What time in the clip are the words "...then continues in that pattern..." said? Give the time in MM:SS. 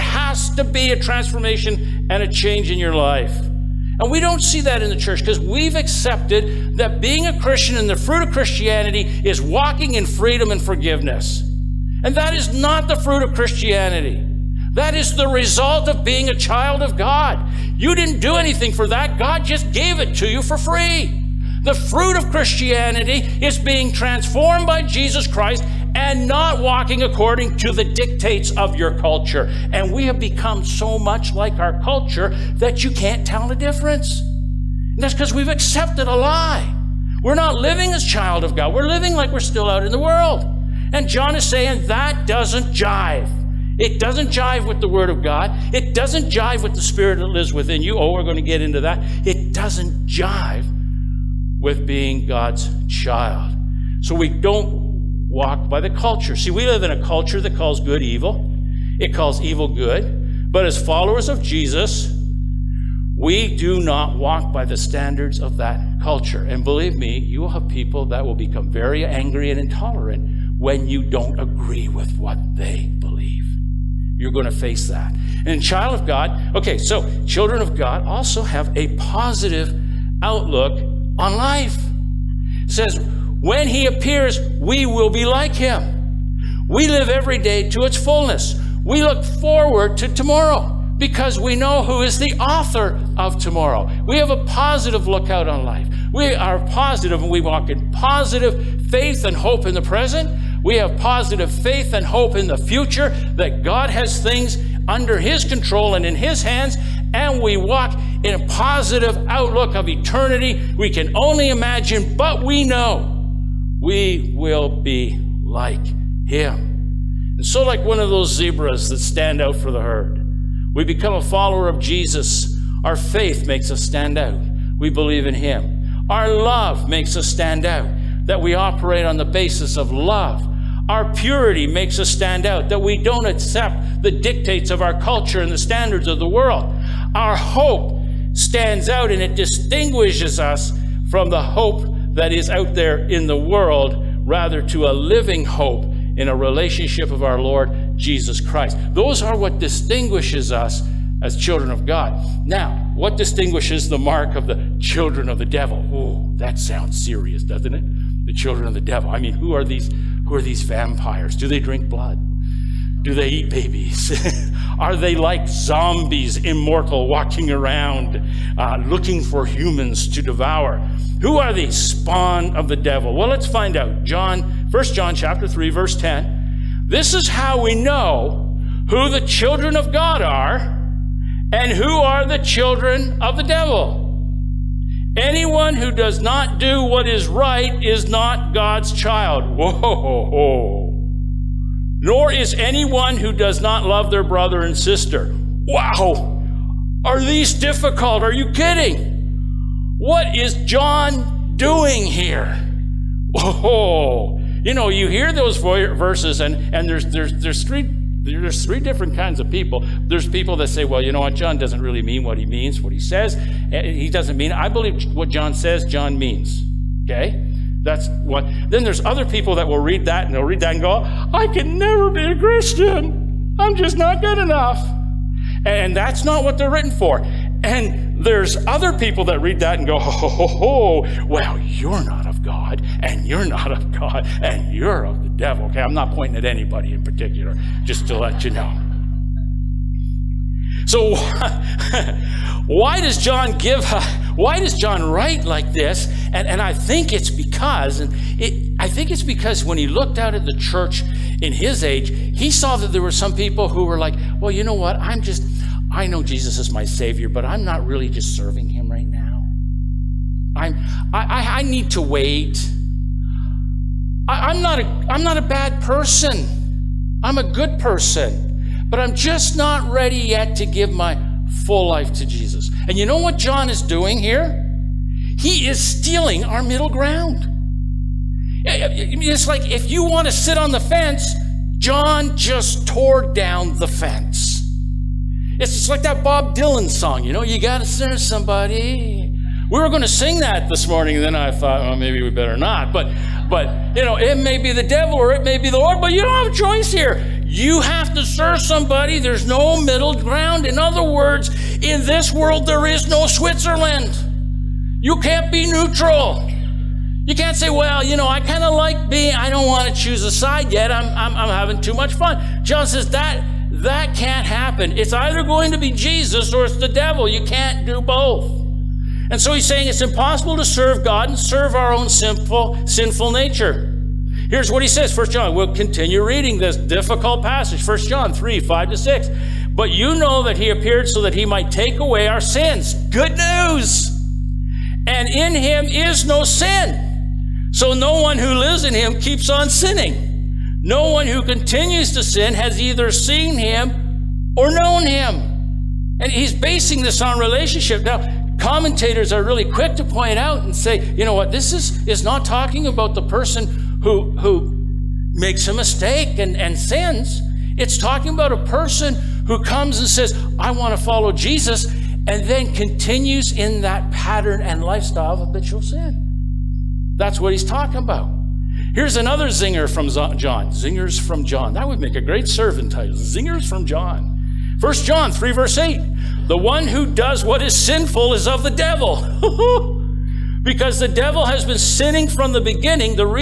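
06:02.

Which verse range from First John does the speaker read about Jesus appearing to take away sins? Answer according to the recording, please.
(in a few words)
1 John 3:5-6.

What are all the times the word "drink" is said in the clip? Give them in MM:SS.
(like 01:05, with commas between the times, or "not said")
02:41.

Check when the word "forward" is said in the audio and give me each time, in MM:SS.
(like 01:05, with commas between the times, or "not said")
01:29.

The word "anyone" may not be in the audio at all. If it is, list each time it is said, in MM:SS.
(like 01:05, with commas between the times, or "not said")
03:05, 03:12.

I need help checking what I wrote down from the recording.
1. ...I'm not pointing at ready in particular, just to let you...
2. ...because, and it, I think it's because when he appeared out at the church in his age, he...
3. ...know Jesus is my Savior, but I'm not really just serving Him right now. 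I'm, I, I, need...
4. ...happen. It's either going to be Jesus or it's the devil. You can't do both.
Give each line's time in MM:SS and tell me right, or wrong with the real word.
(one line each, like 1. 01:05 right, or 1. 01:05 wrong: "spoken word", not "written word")
1. 03:55 wrong: "anybody", not "ready"
2. 04:07 wrong: "looked", not "appeared"
3. 04:16 right
4. 05:14 right.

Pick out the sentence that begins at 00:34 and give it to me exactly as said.
And that's because we've accepted a lie.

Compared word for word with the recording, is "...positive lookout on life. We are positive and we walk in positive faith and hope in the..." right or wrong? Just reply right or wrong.
right.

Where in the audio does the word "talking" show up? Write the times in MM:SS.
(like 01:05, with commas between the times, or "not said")
05:52, 05:57, 06:07.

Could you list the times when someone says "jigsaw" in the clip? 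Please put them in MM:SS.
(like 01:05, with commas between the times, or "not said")
not said.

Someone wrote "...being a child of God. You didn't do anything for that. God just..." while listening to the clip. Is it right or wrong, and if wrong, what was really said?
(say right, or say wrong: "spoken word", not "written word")
right.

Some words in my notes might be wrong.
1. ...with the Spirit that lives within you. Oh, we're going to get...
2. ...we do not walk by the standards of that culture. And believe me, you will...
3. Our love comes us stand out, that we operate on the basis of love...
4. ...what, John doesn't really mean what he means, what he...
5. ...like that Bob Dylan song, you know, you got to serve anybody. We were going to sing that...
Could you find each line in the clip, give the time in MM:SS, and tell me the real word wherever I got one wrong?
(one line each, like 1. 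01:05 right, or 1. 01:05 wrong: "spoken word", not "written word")
1. 00:46 right
2. 01:03 right
3. 02:06 wrong: "makes", not "comes"
4. 03:31 right
5. 04:45 wrong: "somebody", not "anybody".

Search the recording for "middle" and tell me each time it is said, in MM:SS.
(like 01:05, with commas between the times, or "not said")
04:36, 04:59.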